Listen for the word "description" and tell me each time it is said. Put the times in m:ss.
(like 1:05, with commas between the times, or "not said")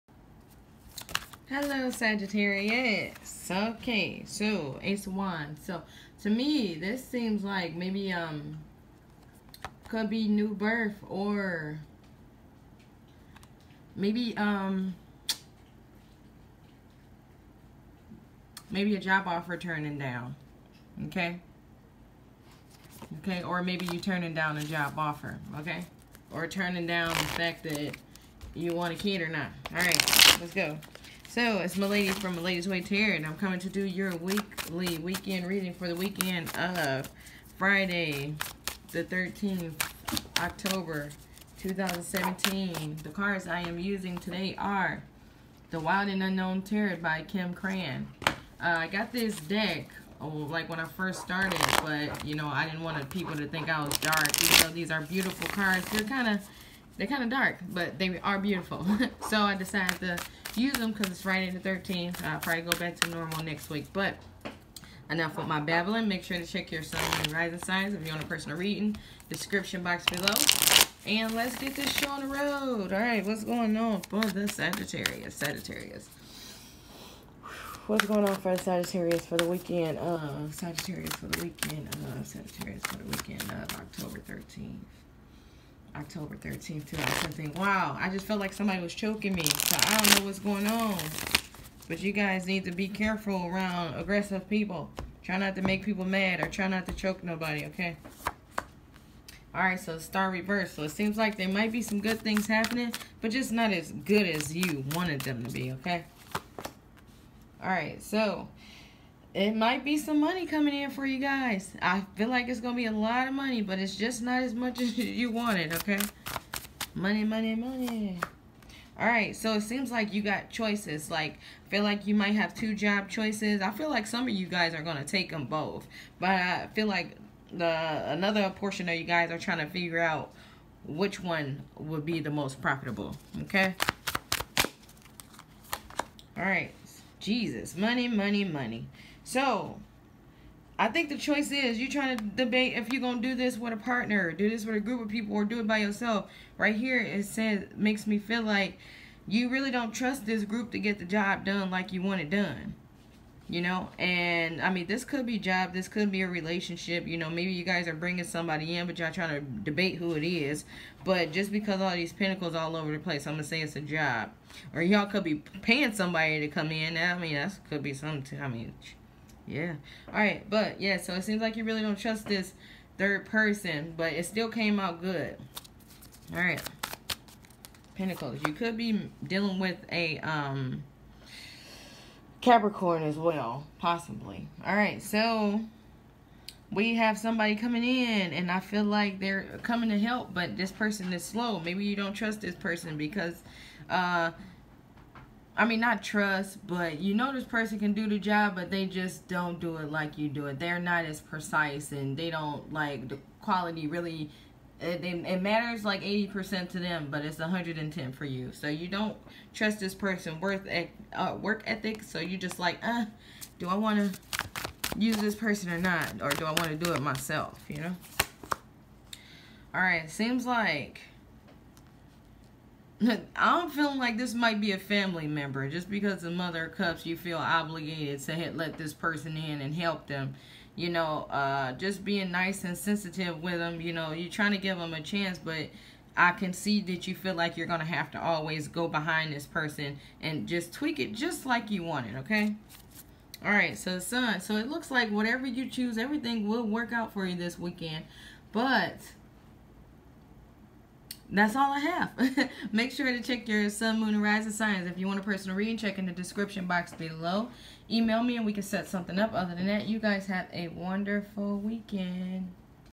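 1:09, 4:16.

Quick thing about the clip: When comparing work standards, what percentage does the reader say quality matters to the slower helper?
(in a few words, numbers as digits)
80%.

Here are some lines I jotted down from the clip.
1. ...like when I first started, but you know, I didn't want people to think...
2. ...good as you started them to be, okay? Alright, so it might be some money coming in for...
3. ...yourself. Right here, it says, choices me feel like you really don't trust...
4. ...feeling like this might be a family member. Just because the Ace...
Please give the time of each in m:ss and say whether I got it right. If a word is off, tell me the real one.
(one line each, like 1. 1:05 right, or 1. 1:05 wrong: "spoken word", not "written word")
1. 0:50 right
2. 1:43 wrong: "wanted", not "started"
3. 2:25 wrong: "makes", not "choices"
4. 3:43 wrong: "Mother", not "Ace".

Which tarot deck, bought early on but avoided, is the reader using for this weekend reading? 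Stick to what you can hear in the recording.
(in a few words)
The Wild and Unknown Tarot.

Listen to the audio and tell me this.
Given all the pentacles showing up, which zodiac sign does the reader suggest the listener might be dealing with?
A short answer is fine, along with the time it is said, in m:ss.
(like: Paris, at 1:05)
Capricorn, at 3:02.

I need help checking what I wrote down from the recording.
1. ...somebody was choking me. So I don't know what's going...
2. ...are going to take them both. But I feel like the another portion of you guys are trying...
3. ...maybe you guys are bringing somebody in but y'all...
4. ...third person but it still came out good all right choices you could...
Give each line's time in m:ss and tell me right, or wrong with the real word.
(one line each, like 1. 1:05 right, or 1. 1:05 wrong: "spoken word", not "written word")
1. 1:28 right
2. 2:04 right
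3. 2:37 right
4. 2:52 wrong: "pentacles", not "choices".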